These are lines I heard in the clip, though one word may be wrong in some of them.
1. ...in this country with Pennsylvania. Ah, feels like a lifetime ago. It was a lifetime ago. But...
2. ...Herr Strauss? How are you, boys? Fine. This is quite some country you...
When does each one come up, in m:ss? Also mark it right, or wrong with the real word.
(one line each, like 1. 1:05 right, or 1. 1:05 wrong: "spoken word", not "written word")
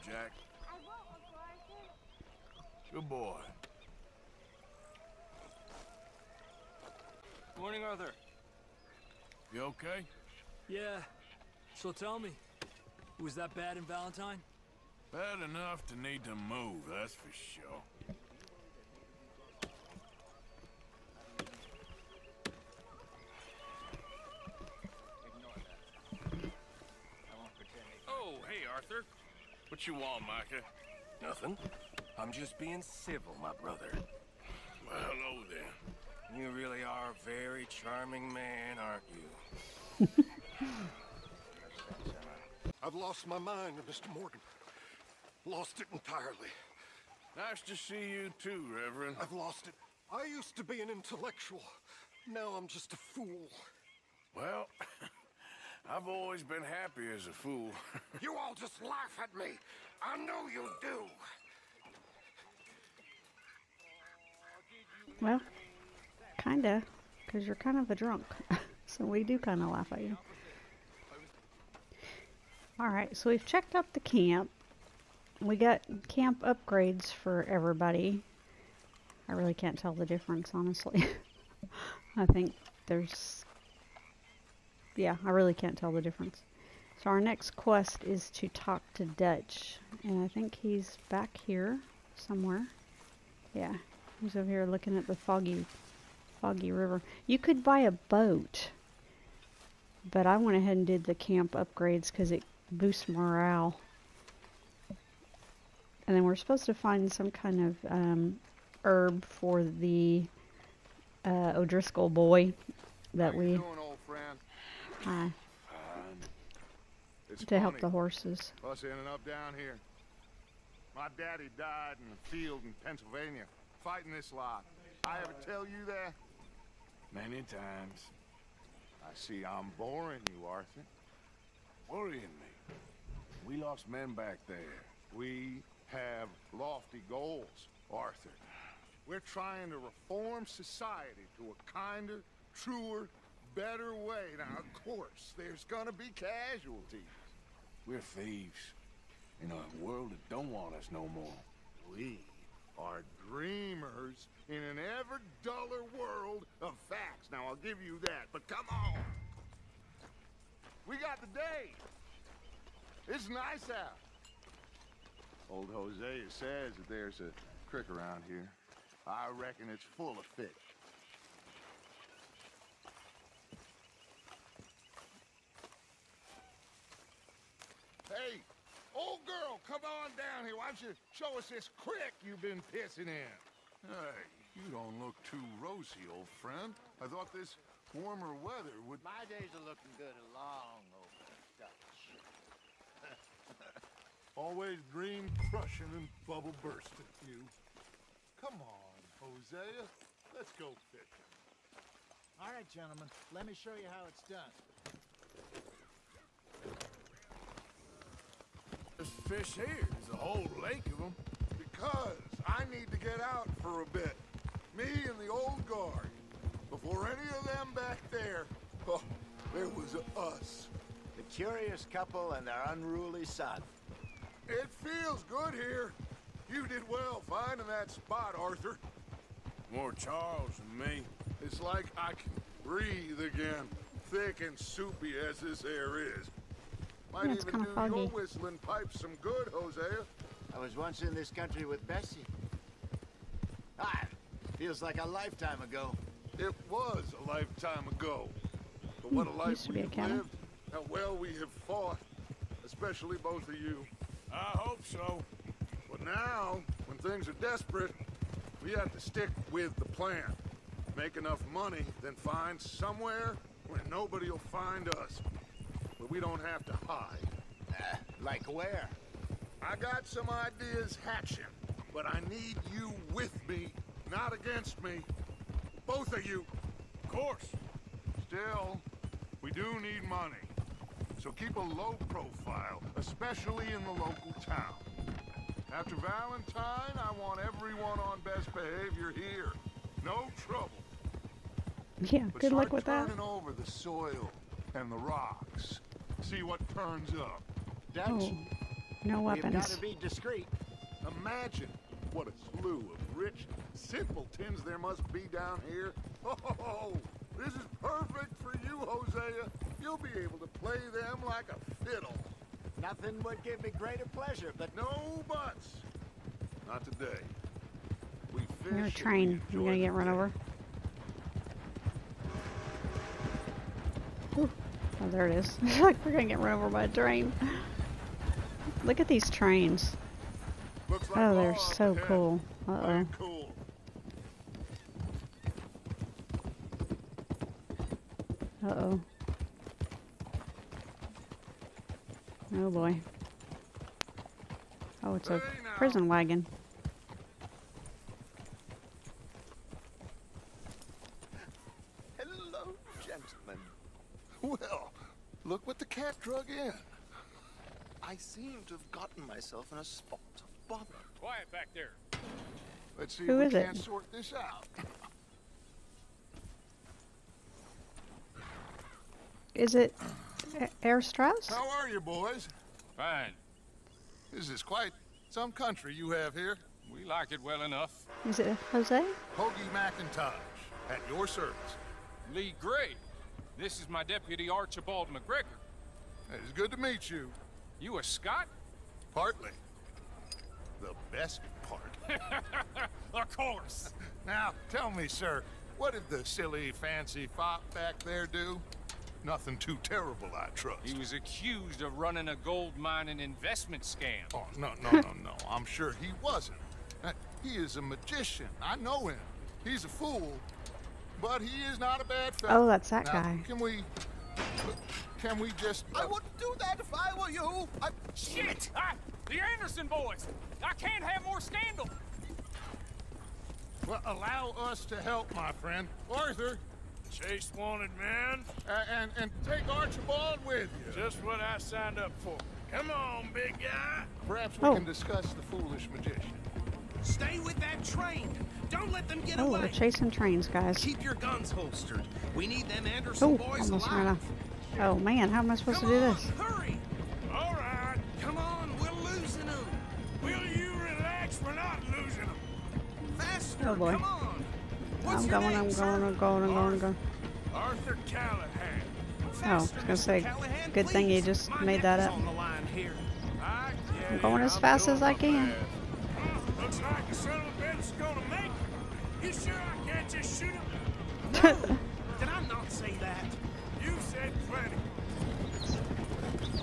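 1. 4:01 wrong: "Bessie", not "Pennsylvania"
2. 6:10 right.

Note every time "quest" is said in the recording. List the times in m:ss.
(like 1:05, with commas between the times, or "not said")
1:27.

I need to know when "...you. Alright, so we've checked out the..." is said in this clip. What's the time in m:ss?
1:10.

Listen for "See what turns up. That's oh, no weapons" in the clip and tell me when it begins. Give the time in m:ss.
4:56.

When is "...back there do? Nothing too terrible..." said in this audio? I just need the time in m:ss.
6:37.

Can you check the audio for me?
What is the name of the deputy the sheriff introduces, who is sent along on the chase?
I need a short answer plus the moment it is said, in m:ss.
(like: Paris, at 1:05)
Archibald McGregor, at 6:24.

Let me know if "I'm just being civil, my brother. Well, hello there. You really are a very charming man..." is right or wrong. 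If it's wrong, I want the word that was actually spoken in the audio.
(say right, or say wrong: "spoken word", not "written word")
right.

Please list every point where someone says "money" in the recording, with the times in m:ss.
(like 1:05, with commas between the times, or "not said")
4:21, 4:40.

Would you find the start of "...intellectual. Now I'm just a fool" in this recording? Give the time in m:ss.
0:50.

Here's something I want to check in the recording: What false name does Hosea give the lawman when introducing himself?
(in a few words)
Hoagie McIntosh.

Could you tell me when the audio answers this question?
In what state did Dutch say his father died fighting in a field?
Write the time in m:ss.
2:02.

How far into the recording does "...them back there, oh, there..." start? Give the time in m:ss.
3:37.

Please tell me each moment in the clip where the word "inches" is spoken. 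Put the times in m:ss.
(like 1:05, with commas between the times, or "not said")
not said.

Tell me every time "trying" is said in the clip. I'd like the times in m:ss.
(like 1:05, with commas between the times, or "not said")
2:19.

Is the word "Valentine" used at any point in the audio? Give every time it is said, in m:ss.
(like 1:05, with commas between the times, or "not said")
0:13, 4:45.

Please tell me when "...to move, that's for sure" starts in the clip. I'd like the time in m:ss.
0:16.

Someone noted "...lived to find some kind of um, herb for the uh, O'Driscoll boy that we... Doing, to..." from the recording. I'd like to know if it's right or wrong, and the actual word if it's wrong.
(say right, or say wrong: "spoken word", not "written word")
wrong: "supposed", not "lived".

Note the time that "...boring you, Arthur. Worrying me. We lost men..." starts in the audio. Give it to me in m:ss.
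2:09.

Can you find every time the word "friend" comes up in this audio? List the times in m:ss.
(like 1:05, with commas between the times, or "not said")
3:06, 7:05.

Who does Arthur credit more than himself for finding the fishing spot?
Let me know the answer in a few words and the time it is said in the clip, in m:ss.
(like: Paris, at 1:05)
Charles, at 3:49.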